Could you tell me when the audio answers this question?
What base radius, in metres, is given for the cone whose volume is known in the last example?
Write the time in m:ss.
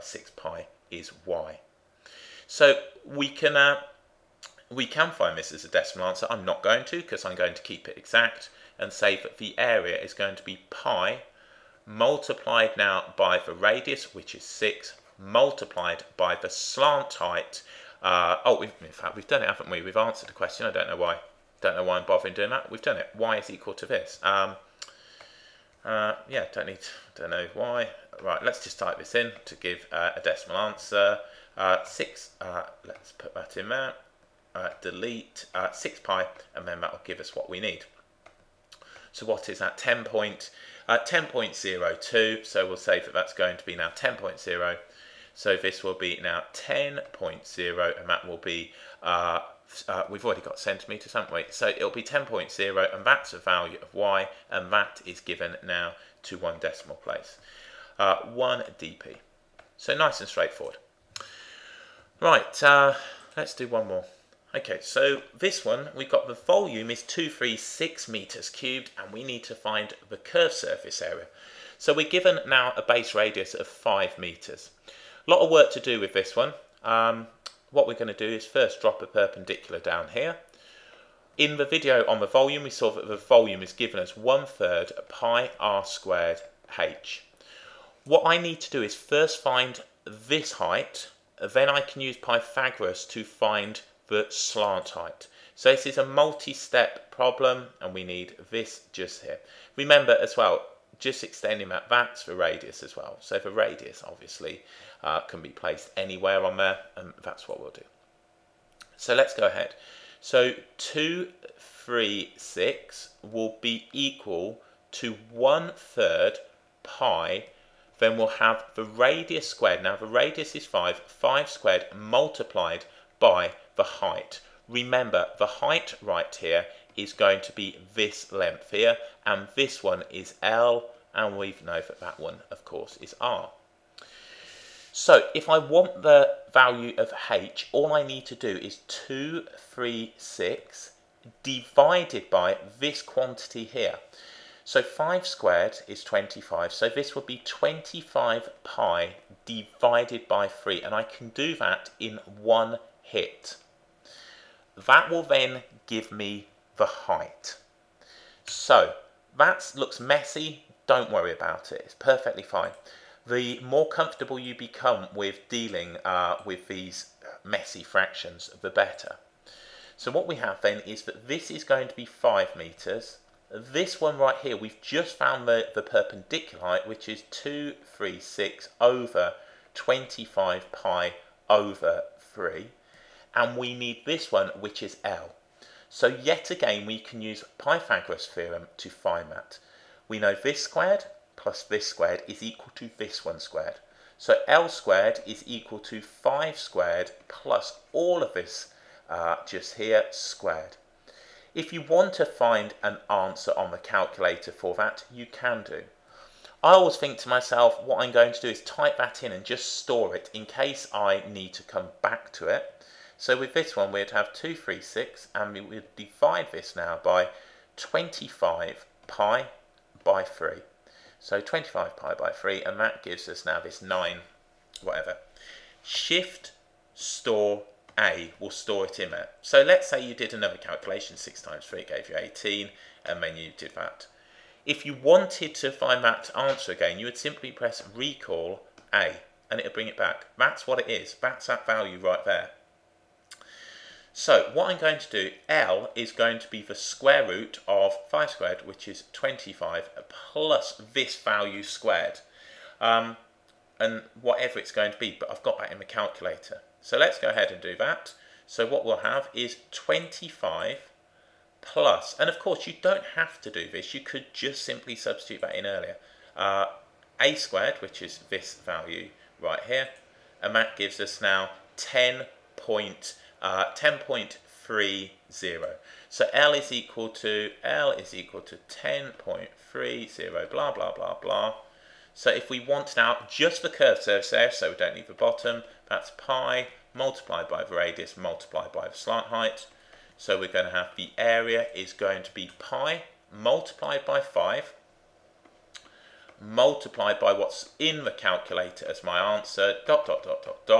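1:12.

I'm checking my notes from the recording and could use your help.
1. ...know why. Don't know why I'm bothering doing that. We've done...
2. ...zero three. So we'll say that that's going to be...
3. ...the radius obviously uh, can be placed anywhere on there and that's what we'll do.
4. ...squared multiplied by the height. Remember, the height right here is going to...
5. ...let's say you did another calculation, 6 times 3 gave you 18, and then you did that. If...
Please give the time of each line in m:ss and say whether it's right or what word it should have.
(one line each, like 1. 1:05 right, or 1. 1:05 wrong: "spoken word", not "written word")
1. 0:20 right
2. 0:41 wrong: "two", not "three"
3. 1:43 right
4. 2:01 right
5. 3:49 right.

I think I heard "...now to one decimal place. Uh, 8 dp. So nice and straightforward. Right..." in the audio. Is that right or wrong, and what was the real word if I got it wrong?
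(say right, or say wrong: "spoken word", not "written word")
wrong: "1", not "8".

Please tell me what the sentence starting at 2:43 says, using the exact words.
The more comfortable you become with dealing uh, with these messy fractions, the better.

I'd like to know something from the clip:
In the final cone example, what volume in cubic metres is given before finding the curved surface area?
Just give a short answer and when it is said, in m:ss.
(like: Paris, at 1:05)
236, at 1:07.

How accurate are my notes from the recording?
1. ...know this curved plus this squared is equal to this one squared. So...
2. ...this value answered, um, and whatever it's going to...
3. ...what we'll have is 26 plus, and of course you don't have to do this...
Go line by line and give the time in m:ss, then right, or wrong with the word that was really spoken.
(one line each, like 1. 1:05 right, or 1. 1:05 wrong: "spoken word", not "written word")
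1. 3:10 wrong: "squared", not "curved"
2. 4:10 wrong: "squared", not "answered"
3. 4:18 wrong: "25", not "26".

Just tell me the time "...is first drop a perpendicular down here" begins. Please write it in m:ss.
1:18.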